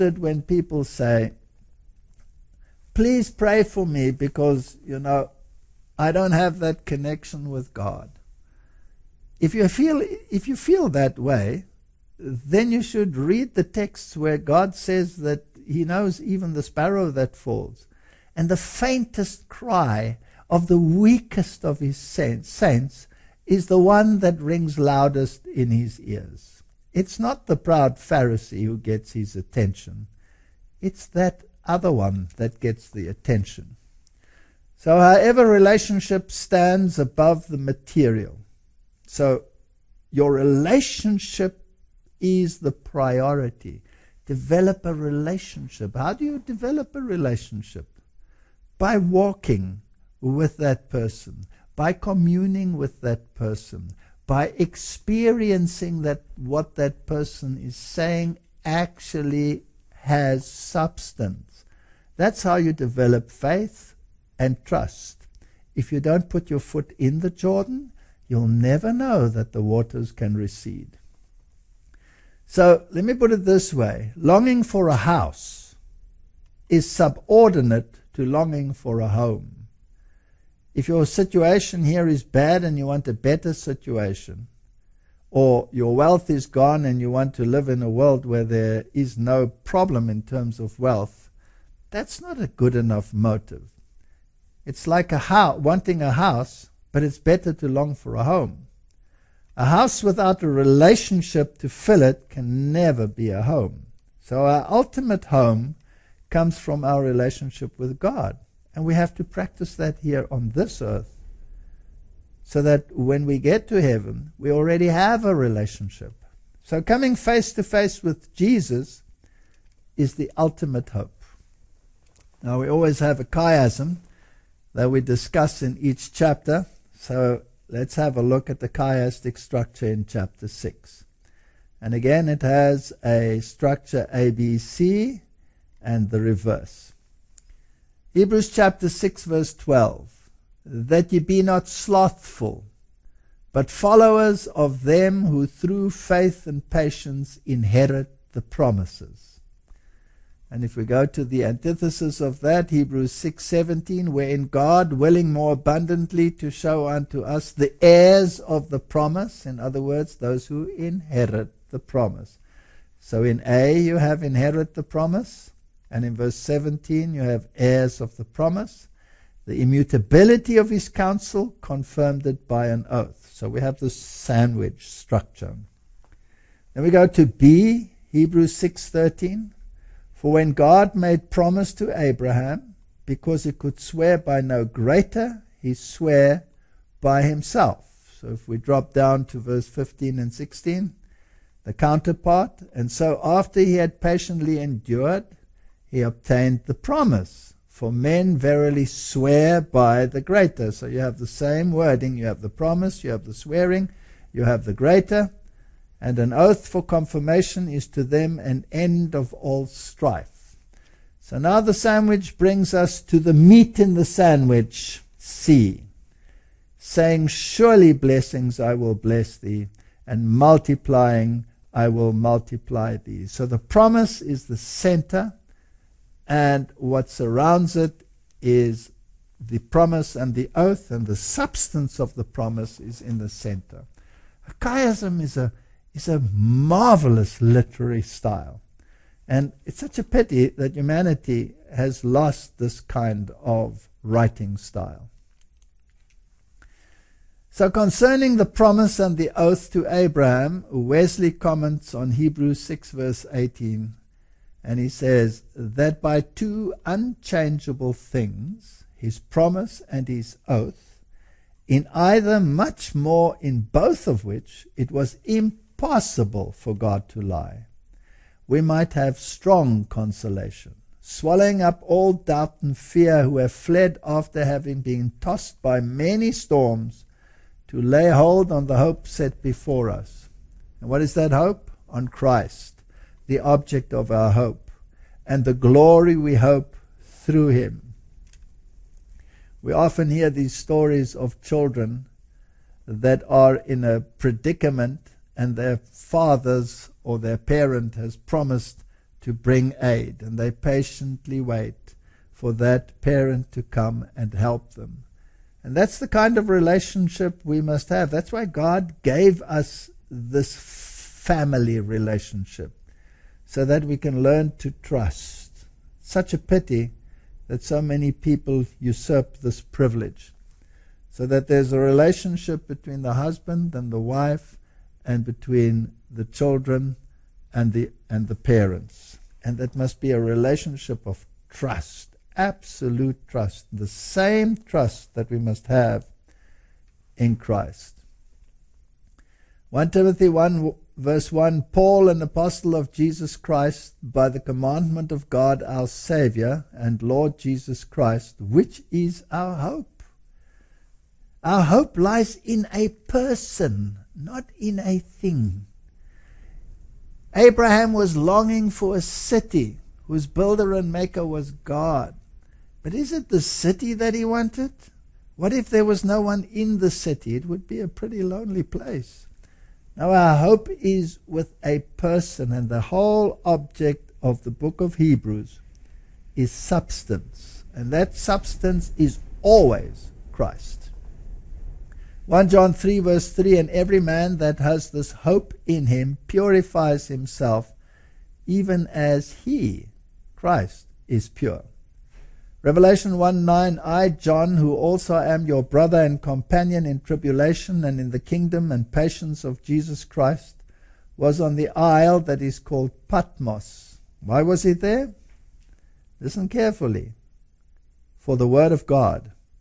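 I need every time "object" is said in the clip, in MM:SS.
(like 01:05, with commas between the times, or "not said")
04:43, 06:13.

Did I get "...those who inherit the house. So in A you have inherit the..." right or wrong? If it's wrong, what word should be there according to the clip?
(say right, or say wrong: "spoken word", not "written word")
wrong: "promise", not "house".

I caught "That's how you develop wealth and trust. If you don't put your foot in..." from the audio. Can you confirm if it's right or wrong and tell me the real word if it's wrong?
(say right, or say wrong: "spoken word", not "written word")
wrong: "faith", not "wealth".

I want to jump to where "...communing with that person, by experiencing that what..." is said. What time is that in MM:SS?
00:51.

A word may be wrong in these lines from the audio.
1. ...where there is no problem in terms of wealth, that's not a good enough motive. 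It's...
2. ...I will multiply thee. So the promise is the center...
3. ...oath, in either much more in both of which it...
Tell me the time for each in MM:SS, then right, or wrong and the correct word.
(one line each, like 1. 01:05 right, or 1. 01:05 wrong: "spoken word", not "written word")
1. 01:28 right
2. 03:41 right
3. 04:20 right.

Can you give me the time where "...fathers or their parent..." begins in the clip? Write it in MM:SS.
04:55.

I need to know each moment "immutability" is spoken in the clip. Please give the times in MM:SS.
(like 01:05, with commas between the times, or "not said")
02:49.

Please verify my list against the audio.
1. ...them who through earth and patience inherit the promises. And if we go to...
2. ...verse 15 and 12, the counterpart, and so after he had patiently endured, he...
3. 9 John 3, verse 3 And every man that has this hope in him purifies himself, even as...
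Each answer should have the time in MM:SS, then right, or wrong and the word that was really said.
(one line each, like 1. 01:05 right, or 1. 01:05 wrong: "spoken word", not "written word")
1. 02:24 wrong: "faith", not "earth"
2. 03:09 wrong: "16", not "12"
3. 06:22 wrong: "1", not "9".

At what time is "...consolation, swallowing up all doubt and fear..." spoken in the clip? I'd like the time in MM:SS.
04:29.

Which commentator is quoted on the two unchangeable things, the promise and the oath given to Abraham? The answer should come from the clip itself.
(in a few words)
Wesley.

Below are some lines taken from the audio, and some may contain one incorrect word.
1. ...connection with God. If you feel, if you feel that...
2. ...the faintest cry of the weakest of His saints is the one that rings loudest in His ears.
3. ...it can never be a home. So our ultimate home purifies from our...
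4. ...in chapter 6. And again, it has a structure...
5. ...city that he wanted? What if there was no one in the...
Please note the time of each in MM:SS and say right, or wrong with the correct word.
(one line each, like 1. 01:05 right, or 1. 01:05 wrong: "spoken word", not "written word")
1. 00:06 right
2. 00:18 right
3. 01:42 wrong: "comes", not "purifies"
4. 02:09 right
5. 06:03 right.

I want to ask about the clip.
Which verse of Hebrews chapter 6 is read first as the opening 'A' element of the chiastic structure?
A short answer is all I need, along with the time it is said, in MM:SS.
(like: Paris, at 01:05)
Hebrews 6:12, at 02:18.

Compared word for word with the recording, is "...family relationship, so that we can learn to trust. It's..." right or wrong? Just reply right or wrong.
right.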